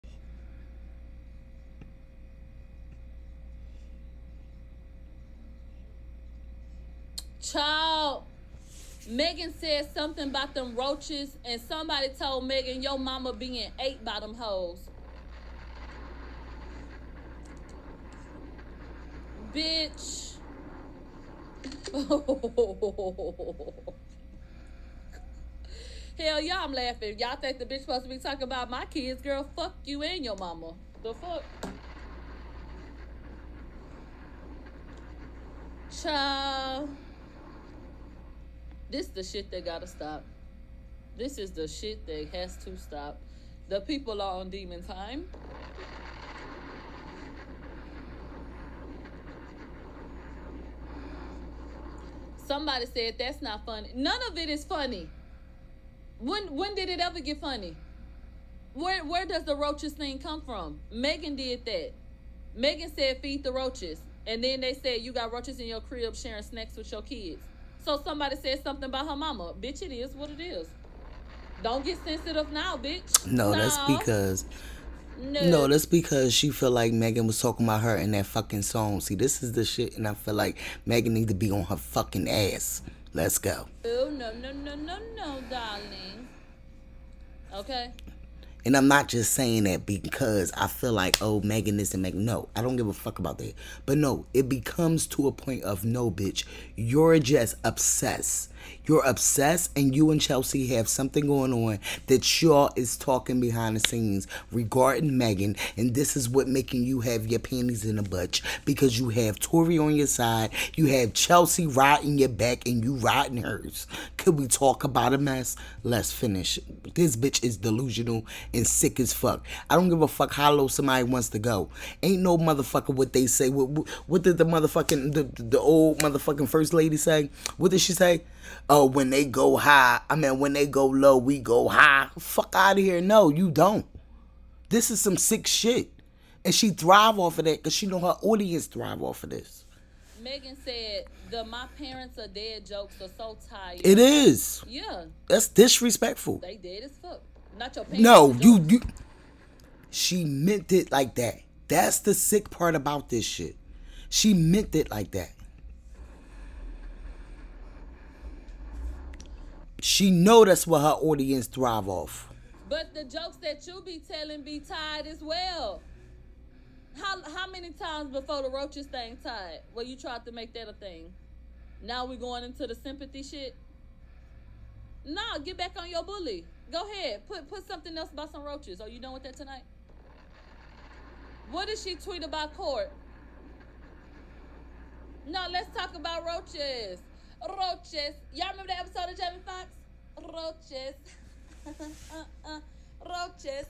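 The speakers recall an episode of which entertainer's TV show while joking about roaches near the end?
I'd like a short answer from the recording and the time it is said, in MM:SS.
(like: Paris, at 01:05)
Jamie Foxx, at 03:09.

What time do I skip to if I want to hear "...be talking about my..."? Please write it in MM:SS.
00:28.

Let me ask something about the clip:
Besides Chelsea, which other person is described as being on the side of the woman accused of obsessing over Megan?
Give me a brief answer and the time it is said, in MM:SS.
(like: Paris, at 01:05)
Tori, at 01:49.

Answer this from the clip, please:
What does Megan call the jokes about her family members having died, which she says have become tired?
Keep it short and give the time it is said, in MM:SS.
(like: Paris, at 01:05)
my parents are dead jokes, at 02:21.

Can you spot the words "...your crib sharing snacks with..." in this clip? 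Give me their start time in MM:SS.
01:05.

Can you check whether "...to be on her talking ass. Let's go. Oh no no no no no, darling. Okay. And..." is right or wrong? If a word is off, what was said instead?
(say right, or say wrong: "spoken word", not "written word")
wrong: "fucking", not "talking".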